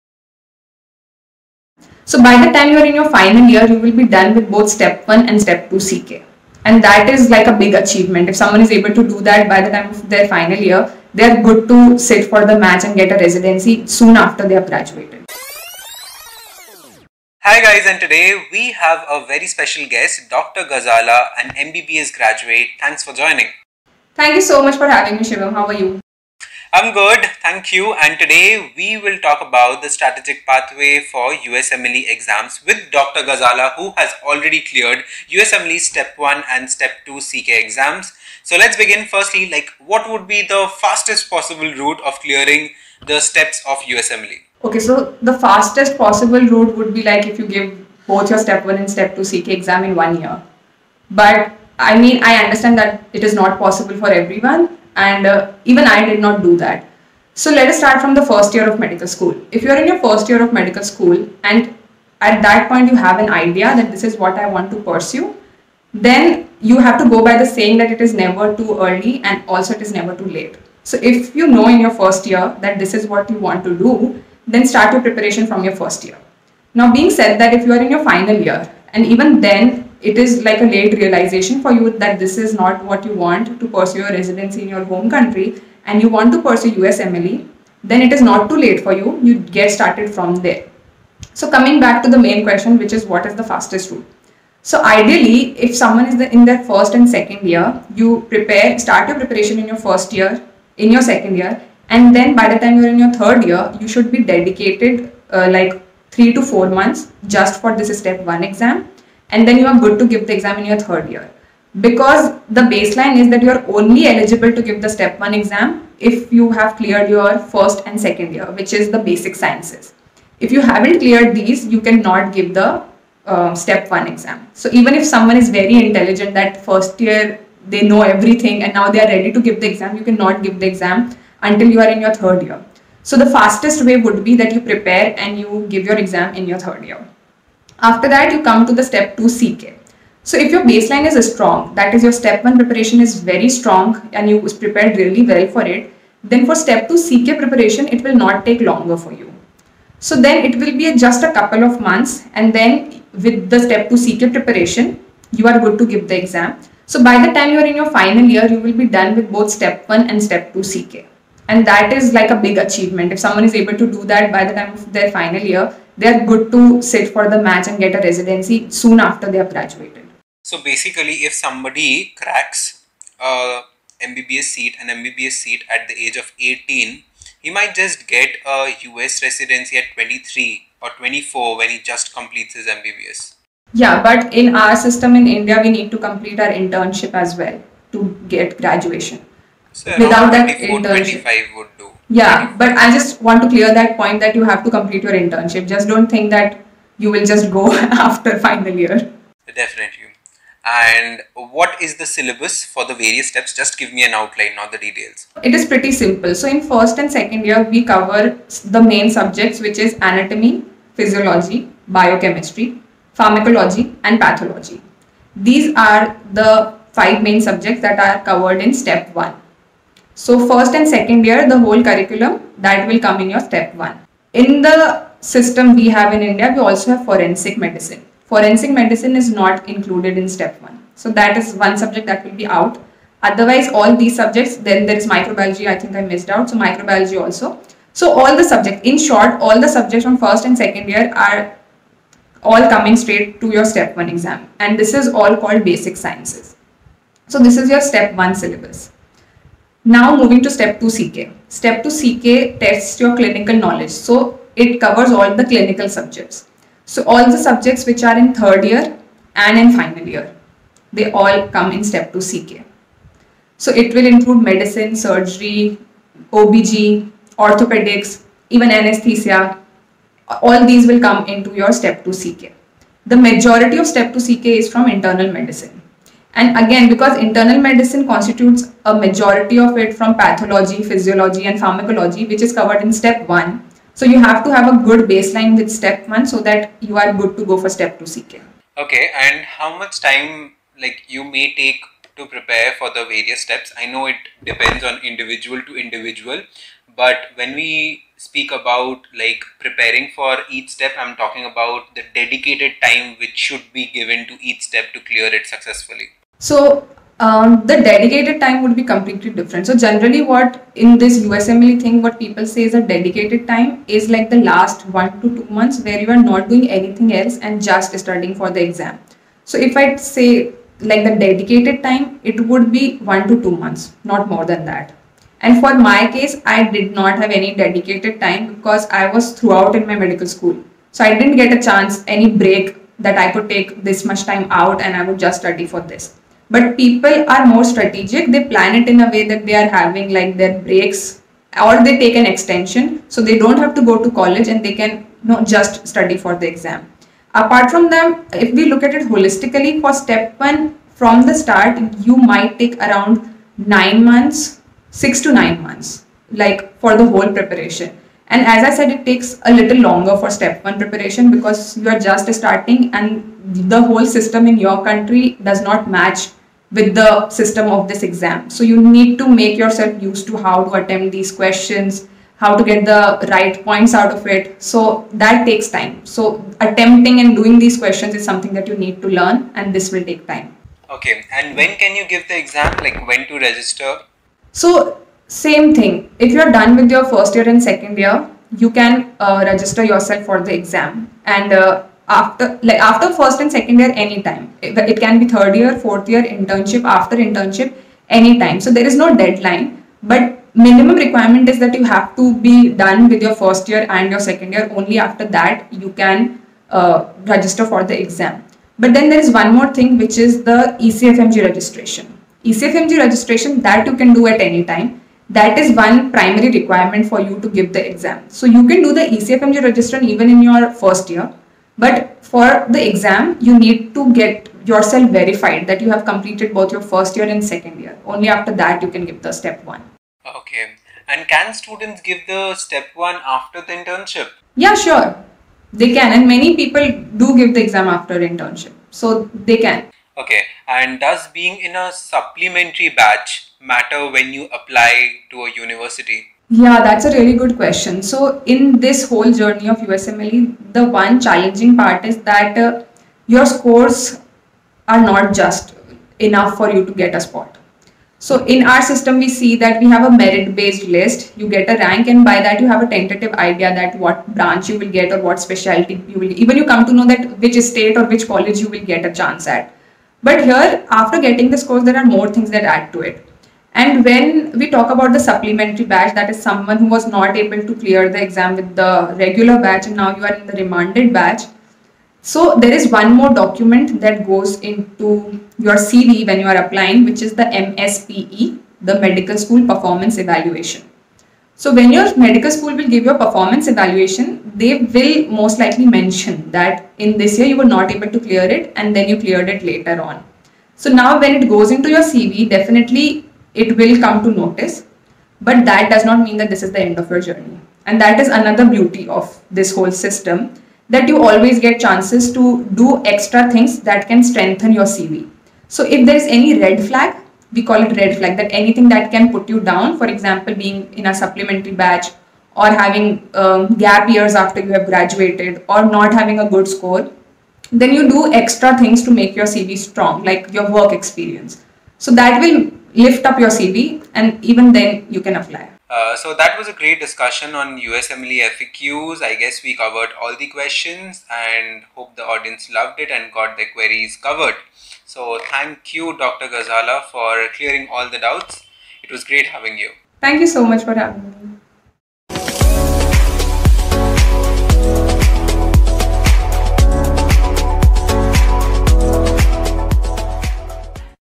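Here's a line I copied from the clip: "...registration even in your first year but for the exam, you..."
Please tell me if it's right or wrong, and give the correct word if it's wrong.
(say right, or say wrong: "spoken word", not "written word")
right.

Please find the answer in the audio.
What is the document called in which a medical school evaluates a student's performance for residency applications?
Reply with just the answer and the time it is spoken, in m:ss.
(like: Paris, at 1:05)
Medical School Performance Evaluation, at 8:08.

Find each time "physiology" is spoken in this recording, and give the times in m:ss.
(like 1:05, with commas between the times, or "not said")
3:30, 4:40.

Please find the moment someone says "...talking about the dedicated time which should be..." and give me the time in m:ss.
5:01.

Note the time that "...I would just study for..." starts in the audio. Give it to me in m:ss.
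5:34.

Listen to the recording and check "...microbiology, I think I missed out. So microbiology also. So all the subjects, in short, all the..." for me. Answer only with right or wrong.
right.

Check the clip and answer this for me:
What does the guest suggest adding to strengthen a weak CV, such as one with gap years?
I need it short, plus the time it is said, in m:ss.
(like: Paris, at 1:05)
Work experience, at 8:50.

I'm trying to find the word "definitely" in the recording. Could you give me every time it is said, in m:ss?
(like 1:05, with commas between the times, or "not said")
3:19, 8:22.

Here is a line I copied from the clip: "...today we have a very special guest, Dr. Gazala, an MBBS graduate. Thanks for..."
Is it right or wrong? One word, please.
right.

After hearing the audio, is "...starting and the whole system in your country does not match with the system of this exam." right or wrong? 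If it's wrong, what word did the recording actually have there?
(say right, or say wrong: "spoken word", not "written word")
right.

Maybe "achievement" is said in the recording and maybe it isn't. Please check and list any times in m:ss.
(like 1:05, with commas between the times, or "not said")
0:07, 2:42.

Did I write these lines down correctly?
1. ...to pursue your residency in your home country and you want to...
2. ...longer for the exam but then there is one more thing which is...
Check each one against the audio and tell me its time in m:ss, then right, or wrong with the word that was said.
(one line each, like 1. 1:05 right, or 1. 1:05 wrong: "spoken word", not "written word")
1. 1:23 right
2. 6:47 wrong: "register", not "longer".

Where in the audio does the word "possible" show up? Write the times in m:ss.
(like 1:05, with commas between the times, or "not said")
0:41, 0:45, 0:53.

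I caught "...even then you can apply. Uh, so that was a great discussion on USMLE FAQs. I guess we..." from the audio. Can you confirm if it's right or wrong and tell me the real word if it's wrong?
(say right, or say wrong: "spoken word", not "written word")
right.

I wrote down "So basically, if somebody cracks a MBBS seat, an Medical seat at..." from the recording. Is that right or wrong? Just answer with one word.
wrong.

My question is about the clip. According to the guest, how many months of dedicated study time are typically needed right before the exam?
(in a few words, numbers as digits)
1 to 2 months.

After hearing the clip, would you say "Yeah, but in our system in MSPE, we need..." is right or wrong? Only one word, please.
wrong.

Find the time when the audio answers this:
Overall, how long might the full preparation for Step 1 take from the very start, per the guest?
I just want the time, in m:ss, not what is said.
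5:54.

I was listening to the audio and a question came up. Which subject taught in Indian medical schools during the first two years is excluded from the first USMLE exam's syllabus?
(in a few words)
Forensic medicine.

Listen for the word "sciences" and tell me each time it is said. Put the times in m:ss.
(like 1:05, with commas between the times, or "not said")
1:59, 4:05.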